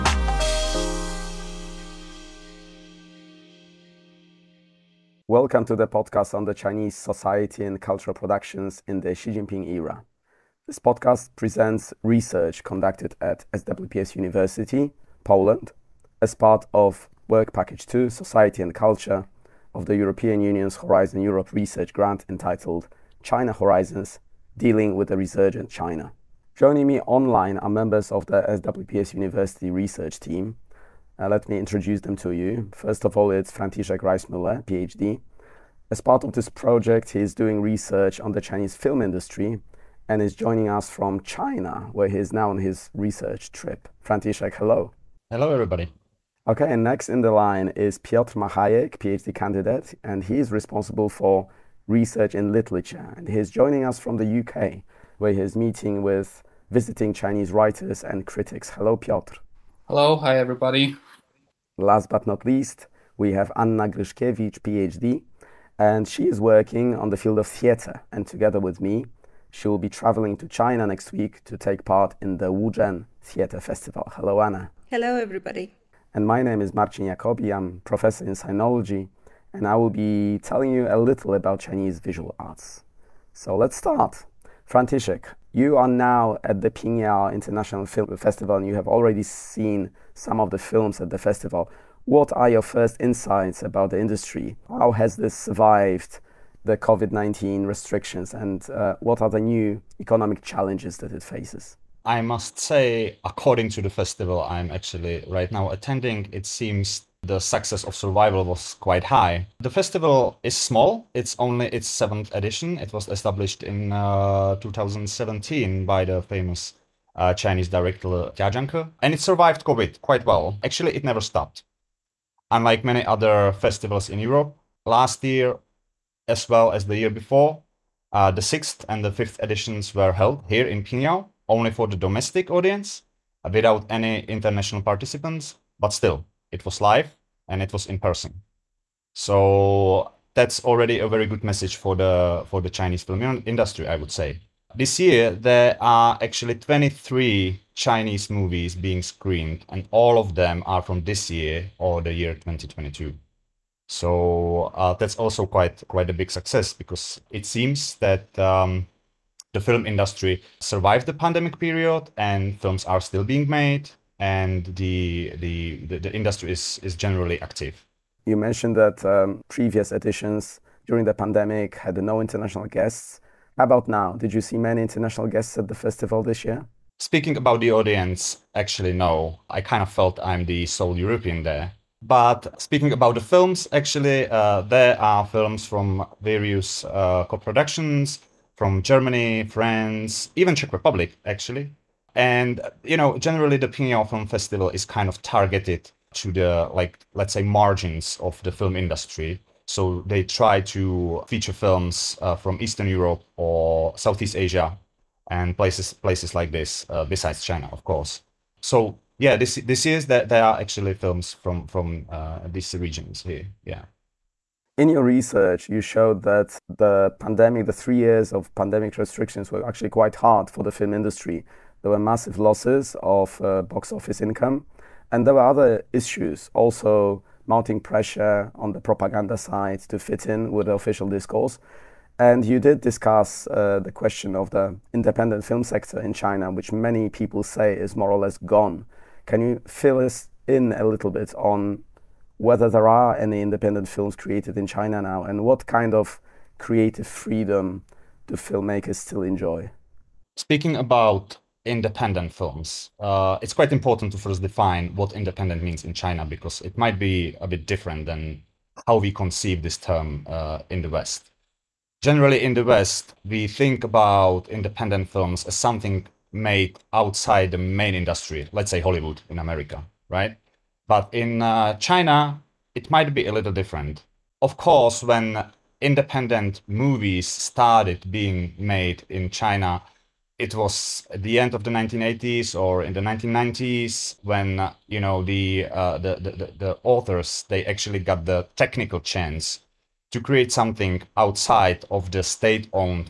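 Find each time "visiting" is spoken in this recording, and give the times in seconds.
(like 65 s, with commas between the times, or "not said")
56 s.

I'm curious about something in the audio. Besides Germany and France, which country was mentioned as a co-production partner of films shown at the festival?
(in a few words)
Czech Republic.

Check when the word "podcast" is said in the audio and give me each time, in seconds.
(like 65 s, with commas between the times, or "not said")
5 s, 10 s.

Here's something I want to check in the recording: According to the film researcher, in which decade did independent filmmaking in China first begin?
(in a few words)
1980s.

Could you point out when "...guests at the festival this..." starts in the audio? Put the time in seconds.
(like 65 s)
175 s.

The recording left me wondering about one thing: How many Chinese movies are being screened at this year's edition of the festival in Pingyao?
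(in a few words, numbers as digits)
23.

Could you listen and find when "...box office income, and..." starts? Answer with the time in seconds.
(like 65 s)
223 s.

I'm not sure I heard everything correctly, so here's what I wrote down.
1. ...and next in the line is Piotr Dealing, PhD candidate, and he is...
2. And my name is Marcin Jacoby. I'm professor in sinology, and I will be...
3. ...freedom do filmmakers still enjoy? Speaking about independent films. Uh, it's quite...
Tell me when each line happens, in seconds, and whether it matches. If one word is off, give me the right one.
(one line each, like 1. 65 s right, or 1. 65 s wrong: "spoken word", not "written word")
1. 46 s wrong: "Machajek", not "Dealing"
2. 76 s right
3. 247 s right.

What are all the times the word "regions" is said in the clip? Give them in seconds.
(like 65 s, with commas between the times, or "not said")
212 s.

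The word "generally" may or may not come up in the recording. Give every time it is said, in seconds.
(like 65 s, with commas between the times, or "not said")
166 s, 193 s, 262 s.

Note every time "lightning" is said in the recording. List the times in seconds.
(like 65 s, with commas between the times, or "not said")
not said.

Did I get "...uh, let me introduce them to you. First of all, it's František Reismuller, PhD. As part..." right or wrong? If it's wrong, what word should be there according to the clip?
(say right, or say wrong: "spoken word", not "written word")
right.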